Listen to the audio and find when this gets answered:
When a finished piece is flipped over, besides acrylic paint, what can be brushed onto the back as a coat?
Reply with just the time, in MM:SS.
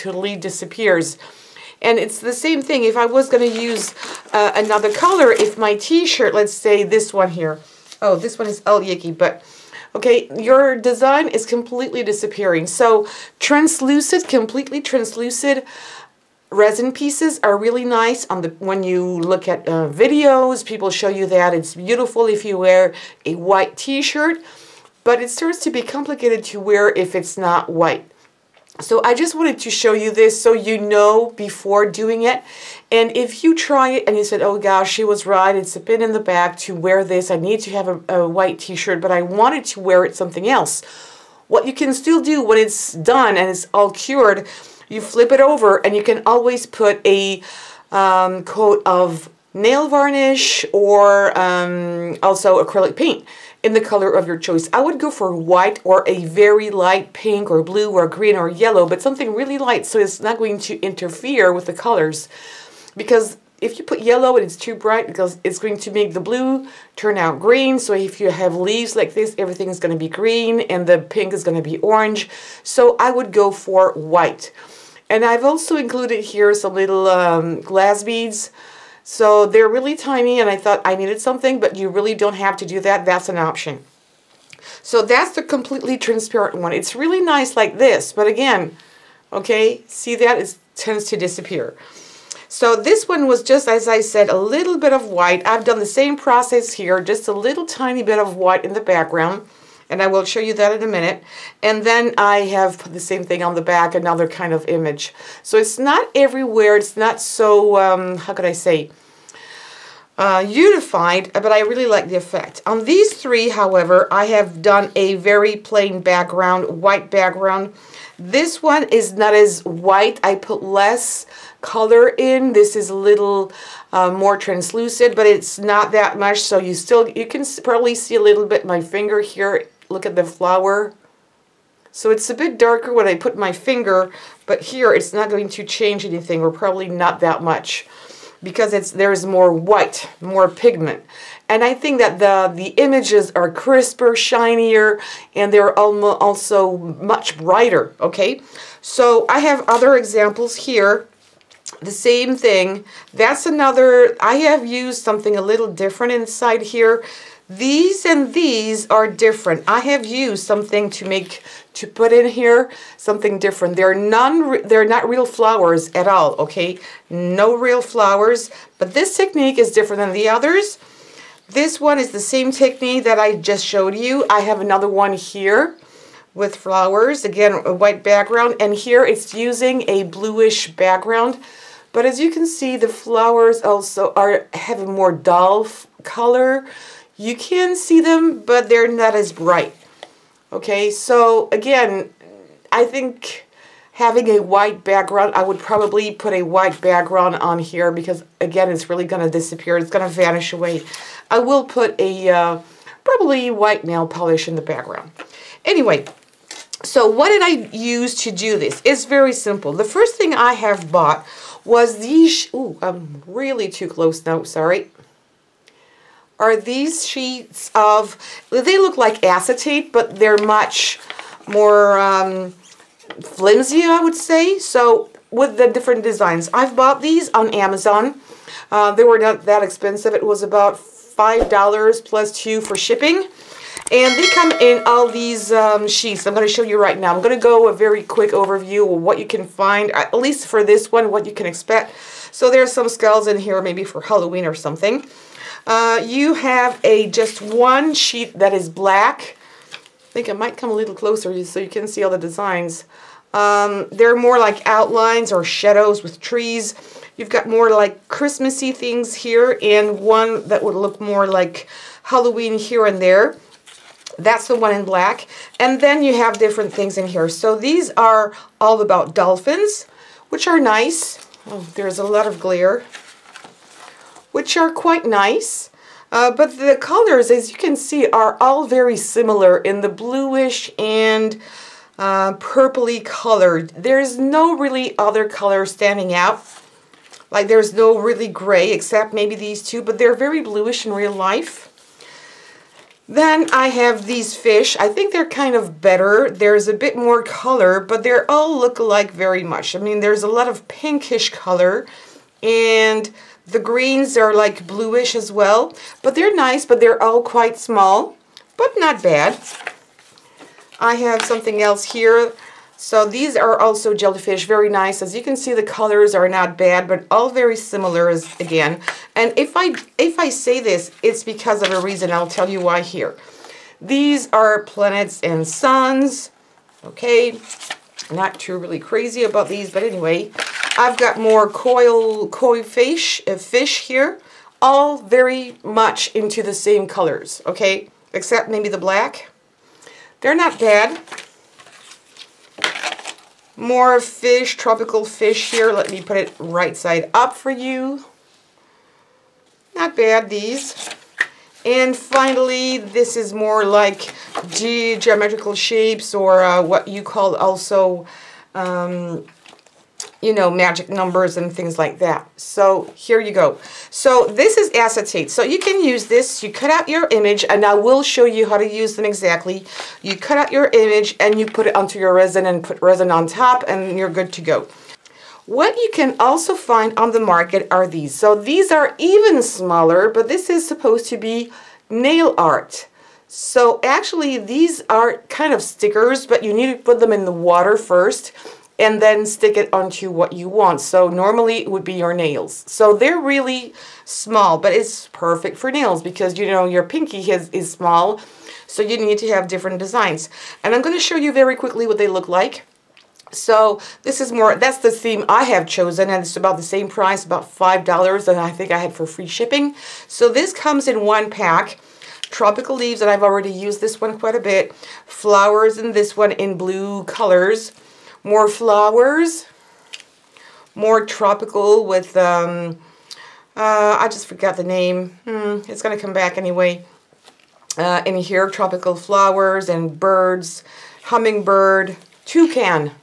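00:49.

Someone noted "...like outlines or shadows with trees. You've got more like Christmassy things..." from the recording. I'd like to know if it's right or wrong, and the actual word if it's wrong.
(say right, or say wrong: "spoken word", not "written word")
right.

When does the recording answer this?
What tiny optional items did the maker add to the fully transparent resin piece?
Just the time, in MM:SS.
01:17.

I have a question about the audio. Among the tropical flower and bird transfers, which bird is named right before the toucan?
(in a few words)
Hummingbird.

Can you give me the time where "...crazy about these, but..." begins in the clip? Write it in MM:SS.
05:28.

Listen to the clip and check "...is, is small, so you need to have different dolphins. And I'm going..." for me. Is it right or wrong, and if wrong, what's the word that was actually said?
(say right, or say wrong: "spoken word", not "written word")
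wrong: "designs", not "dolphins".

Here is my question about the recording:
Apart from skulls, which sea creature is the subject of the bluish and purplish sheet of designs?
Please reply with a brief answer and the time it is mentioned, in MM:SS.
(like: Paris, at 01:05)
Dolphins, at 04:29.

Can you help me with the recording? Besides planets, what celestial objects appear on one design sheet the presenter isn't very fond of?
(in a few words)
Suns.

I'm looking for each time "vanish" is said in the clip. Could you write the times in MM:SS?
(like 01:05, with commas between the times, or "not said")
03:20.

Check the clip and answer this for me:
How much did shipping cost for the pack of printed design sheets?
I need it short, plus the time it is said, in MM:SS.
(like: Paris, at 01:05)
$2, at 03:52.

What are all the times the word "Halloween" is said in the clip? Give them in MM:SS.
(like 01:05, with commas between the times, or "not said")
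04:04, 04:22.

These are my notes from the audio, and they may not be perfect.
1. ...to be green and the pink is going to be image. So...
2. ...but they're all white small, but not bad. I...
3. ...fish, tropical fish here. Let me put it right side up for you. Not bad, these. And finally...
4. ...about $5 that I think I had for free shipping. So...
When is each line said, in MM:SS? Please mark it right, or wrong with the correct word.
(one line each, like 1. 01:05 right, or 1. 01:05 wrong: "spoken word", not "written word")
1. 01:09 wrong: "orange", not "image"
2. 05:06 wrong: "quite", not "white"
3. 05:43 right
4. 06:47 right.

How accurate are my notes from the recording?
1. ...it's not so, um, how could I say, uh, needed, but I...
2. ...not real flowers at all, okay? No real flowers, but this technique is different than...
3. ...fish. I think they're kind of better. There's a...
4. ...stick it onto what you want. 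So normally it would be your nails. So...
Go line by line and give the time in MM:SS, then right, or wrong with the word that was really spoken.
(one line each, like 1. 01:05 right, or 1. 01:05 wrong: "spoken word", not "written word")
1. 01:46 wrong: "unified", not "needed"
2. 02:44 right
3. 04:54 right
4. 06:29 right.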